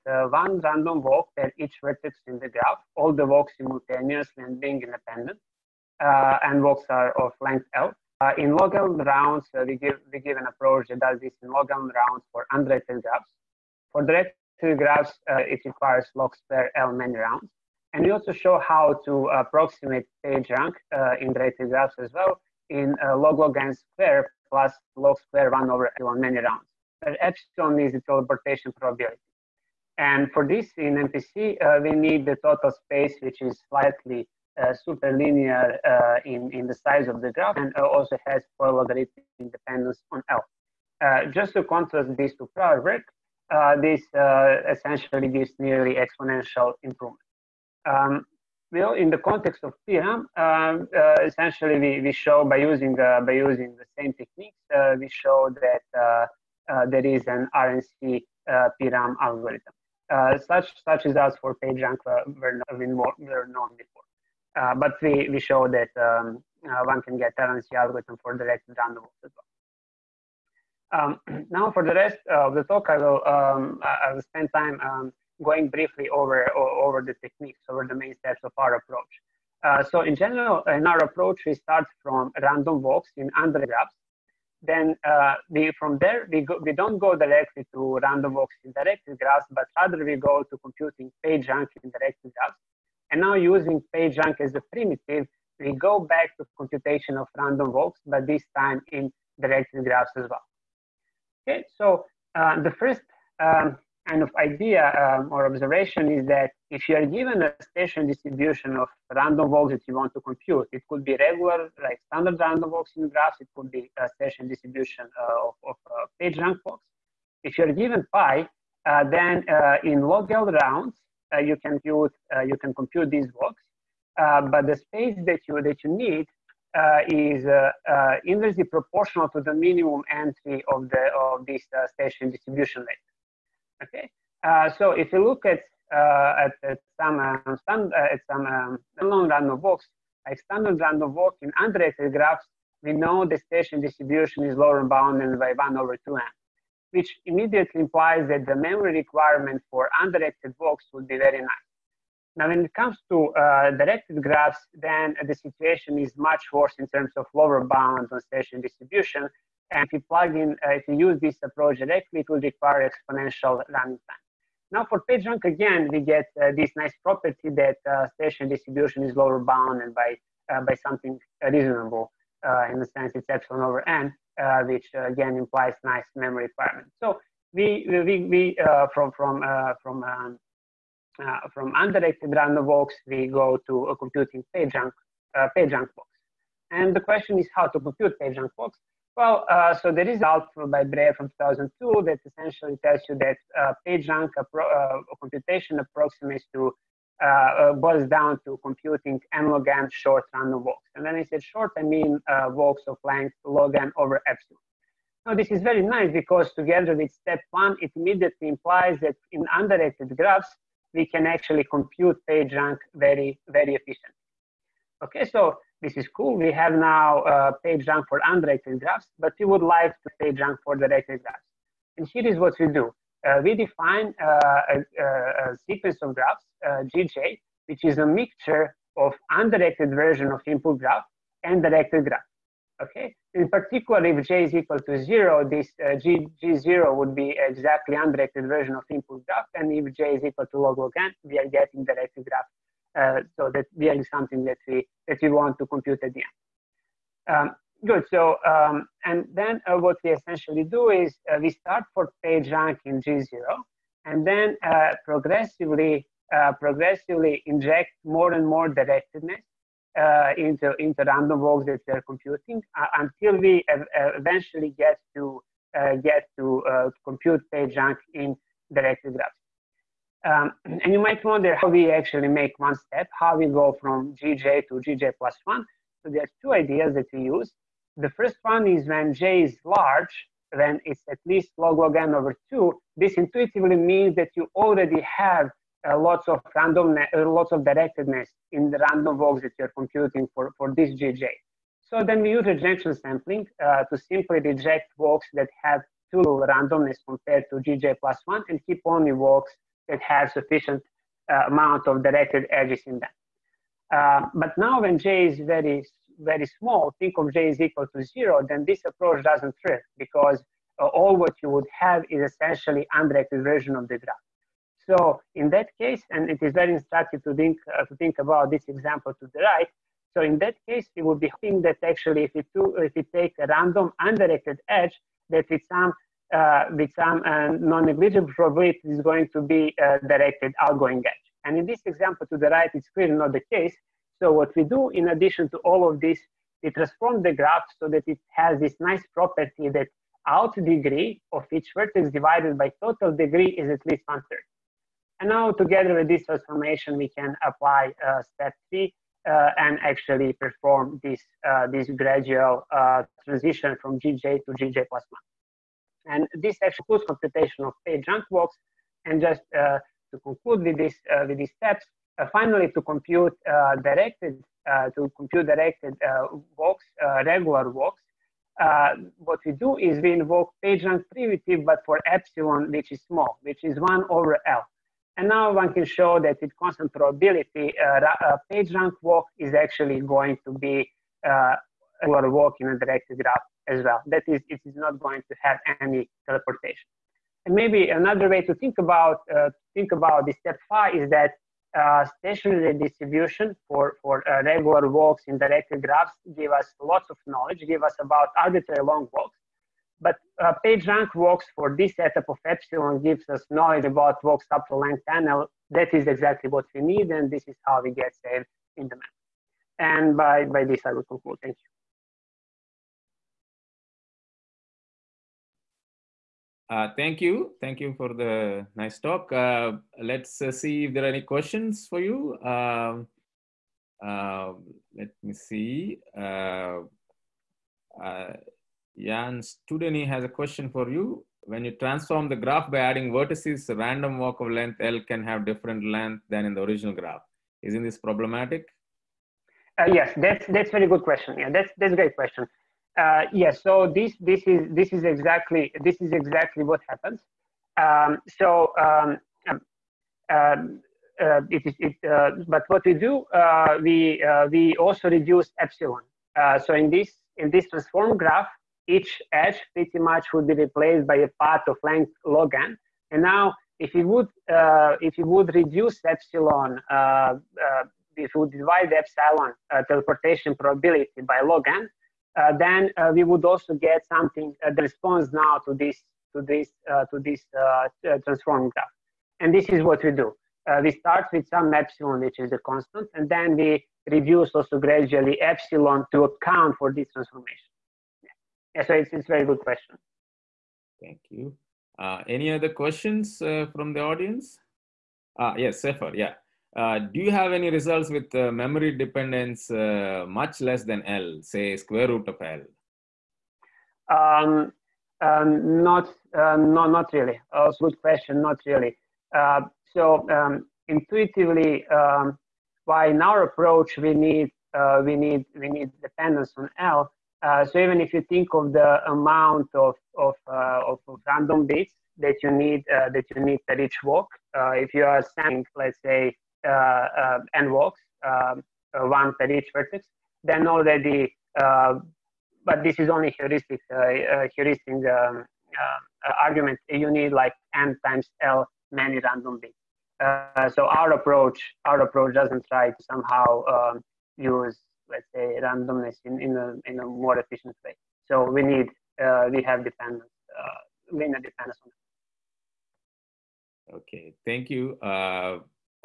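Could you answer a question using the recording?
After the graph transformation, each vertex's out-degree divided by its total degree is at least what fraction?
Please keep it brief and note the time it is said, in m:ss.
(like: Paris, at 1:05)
one third, at 5:44.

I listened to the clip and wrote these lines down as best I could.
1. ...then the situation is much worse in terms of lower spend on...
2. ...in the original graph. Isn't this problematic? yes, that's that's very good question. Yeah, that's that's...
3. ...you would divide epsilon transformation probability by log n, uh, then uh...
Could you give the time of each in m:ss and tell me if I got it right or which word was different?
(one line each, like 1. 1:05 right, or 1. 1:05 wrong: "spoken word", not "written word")
1. 2:34 wrong: "bound", not "spend"
2. 7:16 right
3. 7:48 wrong: "teleportation", not "transformation".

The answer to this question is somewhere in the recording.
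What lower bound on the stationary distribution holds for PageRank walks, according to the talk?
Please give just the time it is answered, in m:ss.
2:53.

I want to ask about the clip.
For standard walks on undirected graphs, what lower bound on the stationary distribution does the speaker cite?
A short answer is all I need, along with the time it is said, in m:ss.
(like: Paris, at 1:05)
1 over 2n, at 2:25.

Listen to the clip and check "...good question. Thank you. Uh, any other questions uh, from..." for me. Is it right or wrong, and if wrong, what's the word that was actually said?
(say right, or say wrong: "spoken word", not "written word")
right.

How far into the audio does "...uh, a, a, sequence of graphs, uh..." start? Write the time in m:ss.
3:44.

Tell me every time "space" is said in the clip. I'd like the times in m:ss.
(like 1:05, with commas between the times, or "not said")
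0:32, 2:04.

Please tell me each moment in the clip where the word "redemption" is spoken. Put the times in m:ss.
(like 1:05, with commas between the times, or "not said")
not said.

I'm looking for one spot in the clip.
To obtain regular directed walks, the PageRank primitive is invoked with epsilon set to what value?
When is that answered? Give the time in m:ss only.
6:13.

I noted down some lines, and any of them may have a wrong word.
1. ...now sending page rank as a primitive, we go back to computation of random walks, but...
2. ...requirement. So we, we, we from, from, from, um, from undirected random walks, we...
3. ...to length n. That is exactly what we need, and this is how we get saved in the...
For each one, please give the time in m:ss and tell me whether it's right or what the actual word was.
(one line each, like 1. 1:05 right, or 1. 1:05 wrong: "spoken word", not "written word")
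1. 1:33 wrong: "using", not "sending"
2. 2:56 right
3. 6:44 right.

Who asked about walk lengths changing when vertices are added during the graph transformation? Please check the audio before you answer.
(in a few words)
Jan Studený.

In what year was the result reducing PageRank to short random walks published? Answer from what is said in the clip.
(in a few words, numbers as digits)
2002.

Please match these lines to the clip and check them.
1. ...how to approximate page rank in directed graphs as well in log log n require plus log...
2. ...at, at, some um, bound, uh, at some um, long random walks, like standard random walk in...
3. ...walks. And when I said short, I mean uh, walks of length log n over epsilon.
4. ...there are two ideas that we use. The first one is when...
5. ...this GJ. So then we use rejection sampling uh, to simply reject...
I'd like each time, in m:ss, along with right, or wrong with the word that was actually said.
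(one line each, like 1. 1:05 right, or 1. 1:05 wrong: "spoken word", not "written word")
1. 0:18 wrong: "square", not "require"
2. 2:16 wrong: "stand", not "bound"
3. 3:20 right
4. 4:36 right
5. 4:50 right.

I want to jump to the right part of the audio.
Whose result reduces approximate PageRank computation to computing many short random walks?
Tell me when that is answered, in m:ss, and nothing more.
3:10.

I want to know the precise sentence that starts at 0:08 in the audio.
Uh, in log log rounds, uh, we, give, we give an approach that does this in log log rounds for undirected graphs.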